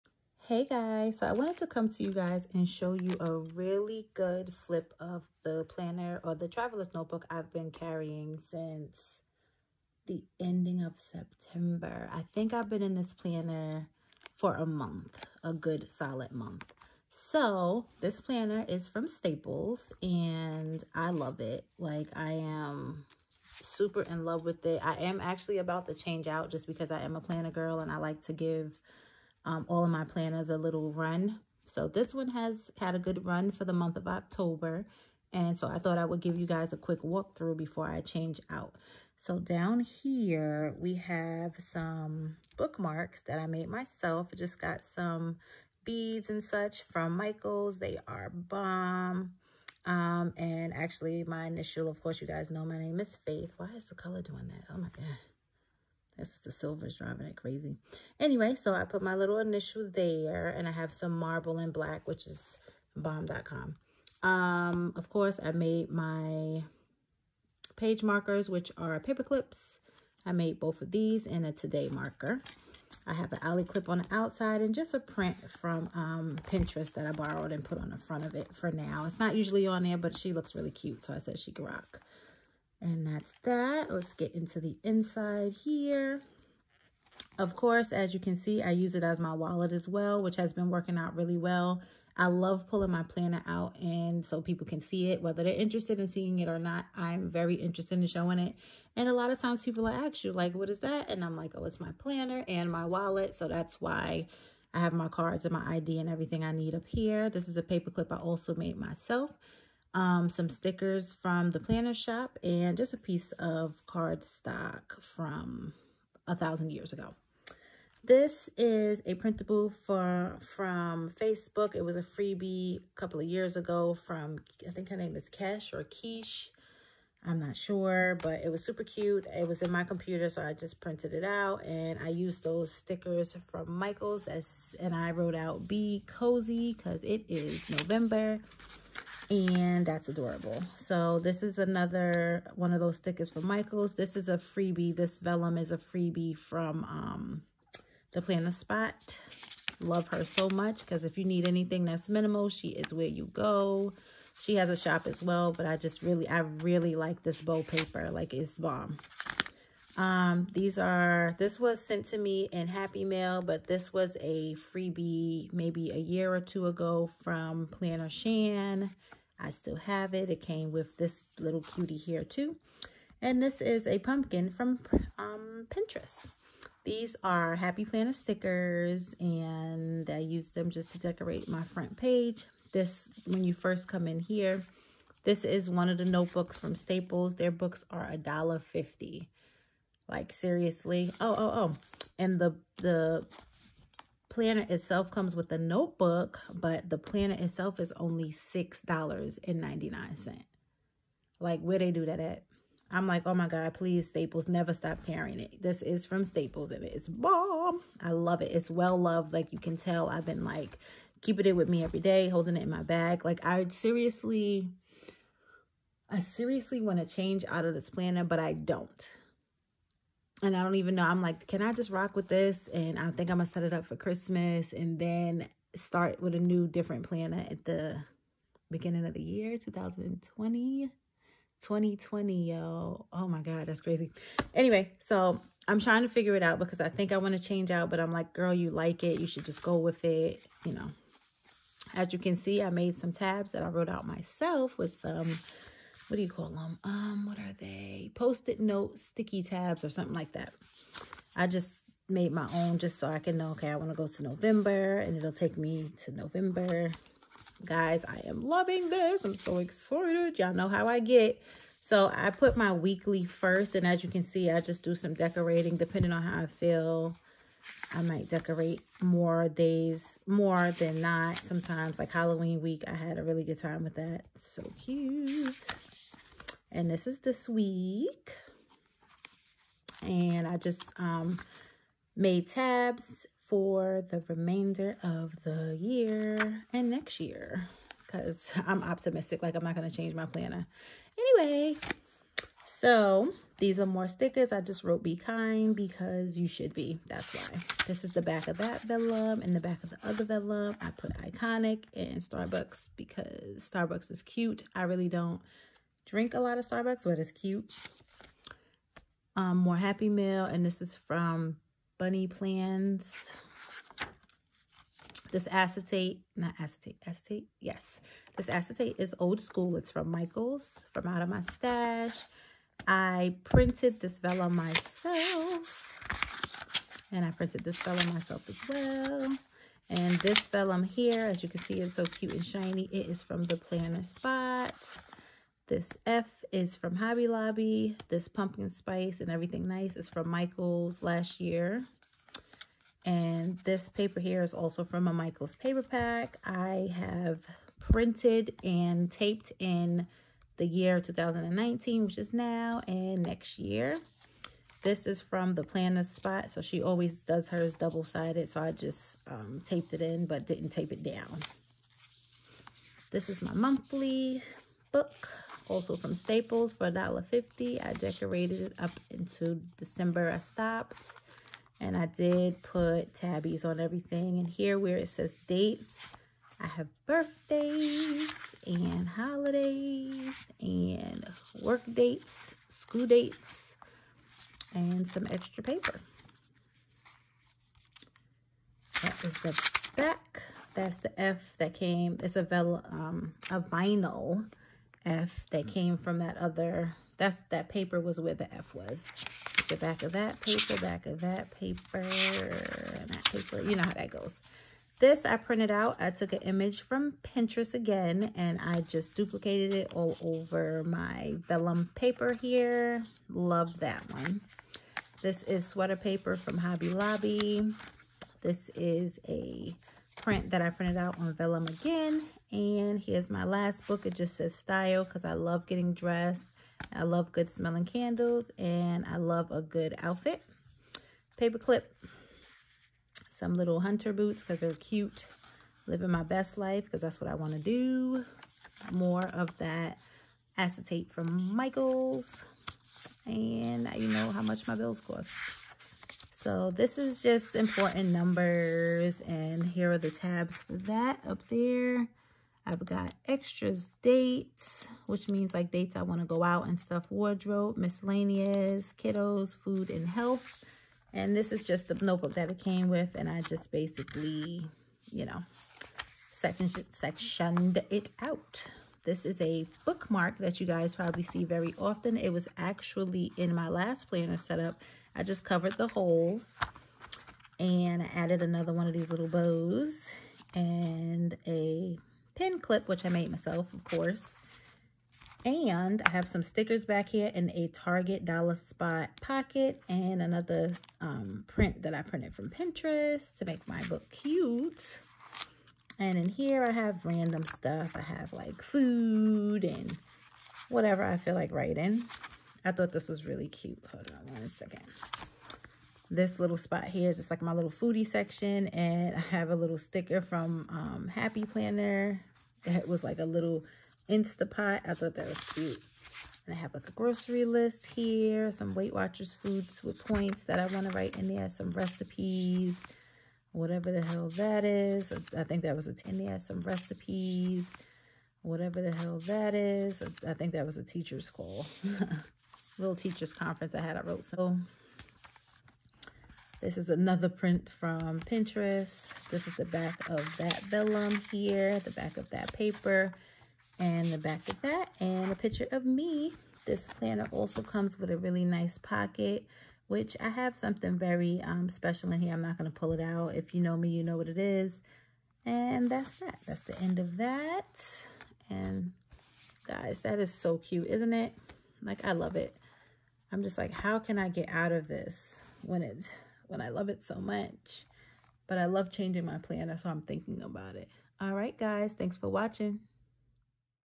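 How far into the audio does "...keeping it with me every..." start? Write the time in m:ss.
3:31.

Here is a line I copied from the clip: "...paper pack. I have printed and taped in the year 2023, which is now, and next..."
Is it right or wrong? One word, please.
wrong.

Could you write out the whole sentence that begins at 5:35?
This F is from Hobby Lobby.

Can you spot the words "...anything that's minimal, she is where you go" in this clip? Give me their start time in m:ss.
2:31.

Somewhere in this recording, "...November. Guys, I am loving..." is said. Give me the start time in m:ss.
4:16.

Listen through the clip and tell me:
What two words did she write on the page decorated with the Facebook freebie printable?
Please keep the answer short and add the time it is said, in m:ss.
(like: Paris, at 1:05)
be cozy, at 2:15.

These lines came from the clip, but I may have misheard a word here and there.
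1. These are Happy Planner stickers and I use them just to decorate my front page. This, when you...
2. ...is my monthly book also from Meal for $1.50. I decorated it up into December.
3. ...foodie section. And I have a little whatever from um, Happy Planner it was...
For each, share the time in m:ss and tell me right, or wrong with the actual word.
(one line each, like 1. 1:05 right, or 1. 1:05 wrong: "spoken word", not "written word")
1. 2:56 right
2. 6:03 wrong: "Staples", not "Meal"
3. 8:27 wrong: "sticker", not "whatever".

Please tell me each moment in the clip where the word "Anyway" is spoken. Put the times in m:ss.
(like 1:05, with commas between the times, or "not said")
0:58, 3:54, 4:51.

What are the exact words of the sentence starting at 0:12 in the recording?
I think I've been in this planner for a month, a good solid month.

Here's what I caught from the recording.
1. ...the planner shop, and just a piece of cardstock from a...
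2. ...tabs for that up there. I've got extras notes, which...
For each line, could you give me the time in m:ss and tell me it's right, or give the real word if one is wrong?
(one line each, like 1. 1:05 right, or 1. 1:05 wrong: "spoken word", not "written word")
1. 1:51 right
2. 7:30 wrong: "dates", not "notes".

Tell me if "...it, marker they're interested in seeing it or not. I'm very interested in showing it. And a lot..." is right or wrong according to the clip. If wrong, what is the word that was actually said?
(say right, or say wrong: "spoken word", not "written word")
wrong: "whether", not "marker".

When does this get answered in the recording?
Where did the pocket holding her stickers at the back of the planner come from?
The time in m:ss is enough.
8:07.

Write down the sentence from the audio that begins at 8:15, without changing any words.
And in here I have random stuff.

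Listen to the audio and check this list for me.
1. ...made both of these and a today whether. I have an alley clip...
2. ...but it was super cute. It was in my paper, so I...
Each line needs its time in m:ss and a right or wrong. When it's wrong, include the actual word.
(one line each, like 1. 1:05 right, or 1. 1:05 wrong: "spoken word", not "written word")
1. 1:10 wrong: "marker", not "whether"
2. 2:08 wrong: "computer", not "paper".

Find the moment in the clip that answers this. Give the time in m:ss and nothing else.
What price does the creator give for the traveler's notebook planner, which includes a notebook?
3:18.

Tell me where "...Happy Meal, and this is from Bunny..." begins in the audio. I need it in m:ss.
5:09.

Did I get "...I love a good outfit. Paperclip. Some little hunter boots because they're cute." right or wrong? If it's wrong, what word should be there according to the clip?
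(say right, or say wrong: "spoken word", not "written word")
right.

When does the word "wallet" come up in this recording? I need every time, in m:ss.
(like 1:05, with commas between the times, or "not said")
1:29, 1:42.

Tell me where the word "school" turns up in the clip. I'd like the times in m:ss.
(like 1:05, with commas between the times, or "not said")
5:19, 6:22.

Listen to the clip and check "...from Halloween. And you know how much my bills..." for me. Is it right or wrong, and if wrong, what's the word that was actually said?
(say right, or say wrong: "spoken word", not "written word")
wrong: "Michaels", not "Halloween".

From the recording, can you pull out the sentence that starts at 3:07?
Their books are a dollar fifty.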